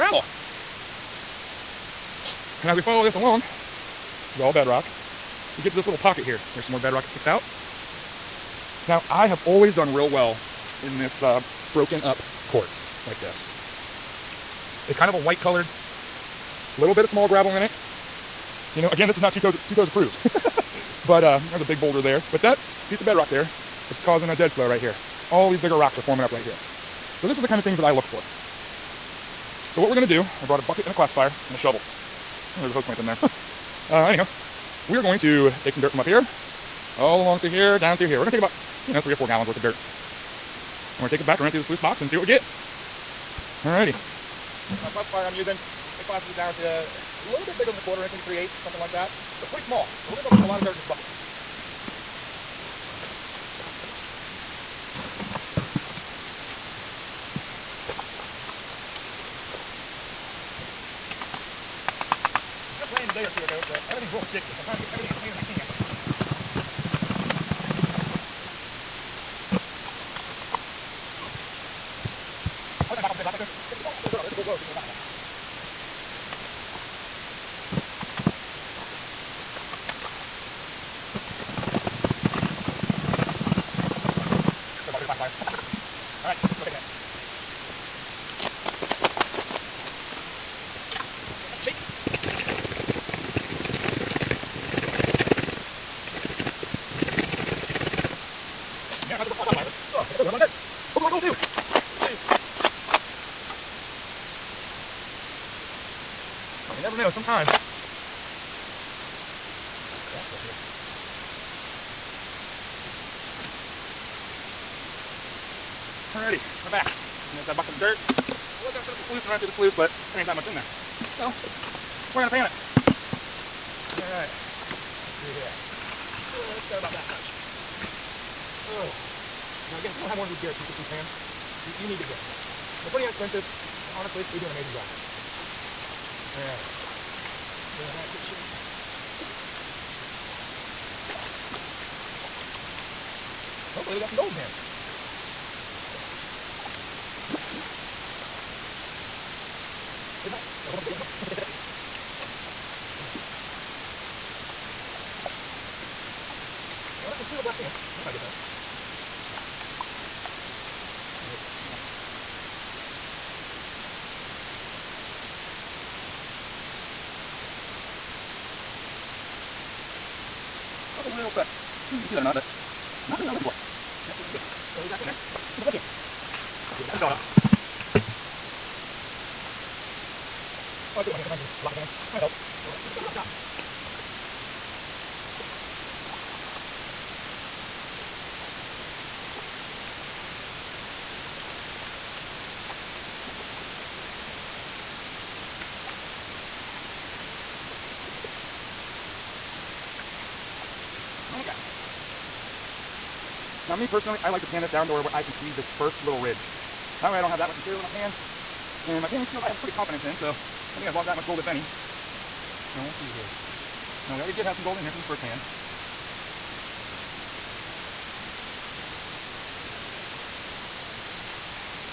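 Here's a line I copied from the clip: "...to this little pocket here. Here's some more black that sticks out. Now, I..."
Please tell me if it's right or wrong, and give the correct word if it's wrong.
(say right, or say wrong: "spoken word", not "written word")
wrong: "bedrock", not "black".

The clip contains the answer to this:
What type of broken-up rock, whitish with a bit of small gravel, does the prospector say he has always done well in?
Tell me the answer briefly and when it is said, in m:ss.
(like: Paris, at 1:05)
quartz, at 0:12.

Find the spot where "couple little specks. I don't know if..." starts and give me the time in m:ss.
2:50.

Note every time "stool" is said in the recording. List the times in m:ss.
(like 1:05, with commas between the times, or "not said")
not said.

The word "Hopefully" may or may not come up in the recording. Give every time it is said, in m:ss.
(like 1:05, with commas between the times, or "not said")
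1:40, 2:23.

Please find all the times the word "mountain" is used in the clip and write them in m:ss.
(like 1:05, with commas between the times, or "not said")
not said.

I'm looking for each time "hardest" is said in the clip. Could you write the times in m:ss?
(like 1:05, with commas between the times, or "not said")
not said.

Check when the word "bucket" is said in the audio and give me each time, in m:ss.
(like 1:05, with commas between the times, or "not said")
0:30, 0:50, 1:57.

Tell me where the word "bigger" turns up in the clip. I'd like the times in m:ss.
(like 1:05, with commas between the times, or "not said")
0:25, 0:47.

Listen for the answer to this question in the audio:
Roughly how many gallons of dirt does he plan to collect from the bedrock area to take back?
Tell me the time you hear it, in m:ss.
0:39.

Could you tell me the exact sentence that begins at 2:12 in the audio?
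They're pretty inexpensive, and honestly, they do an amazing job.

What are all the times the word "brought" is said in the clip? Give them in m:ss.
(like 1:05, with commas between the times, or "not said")
0:30, 1:39.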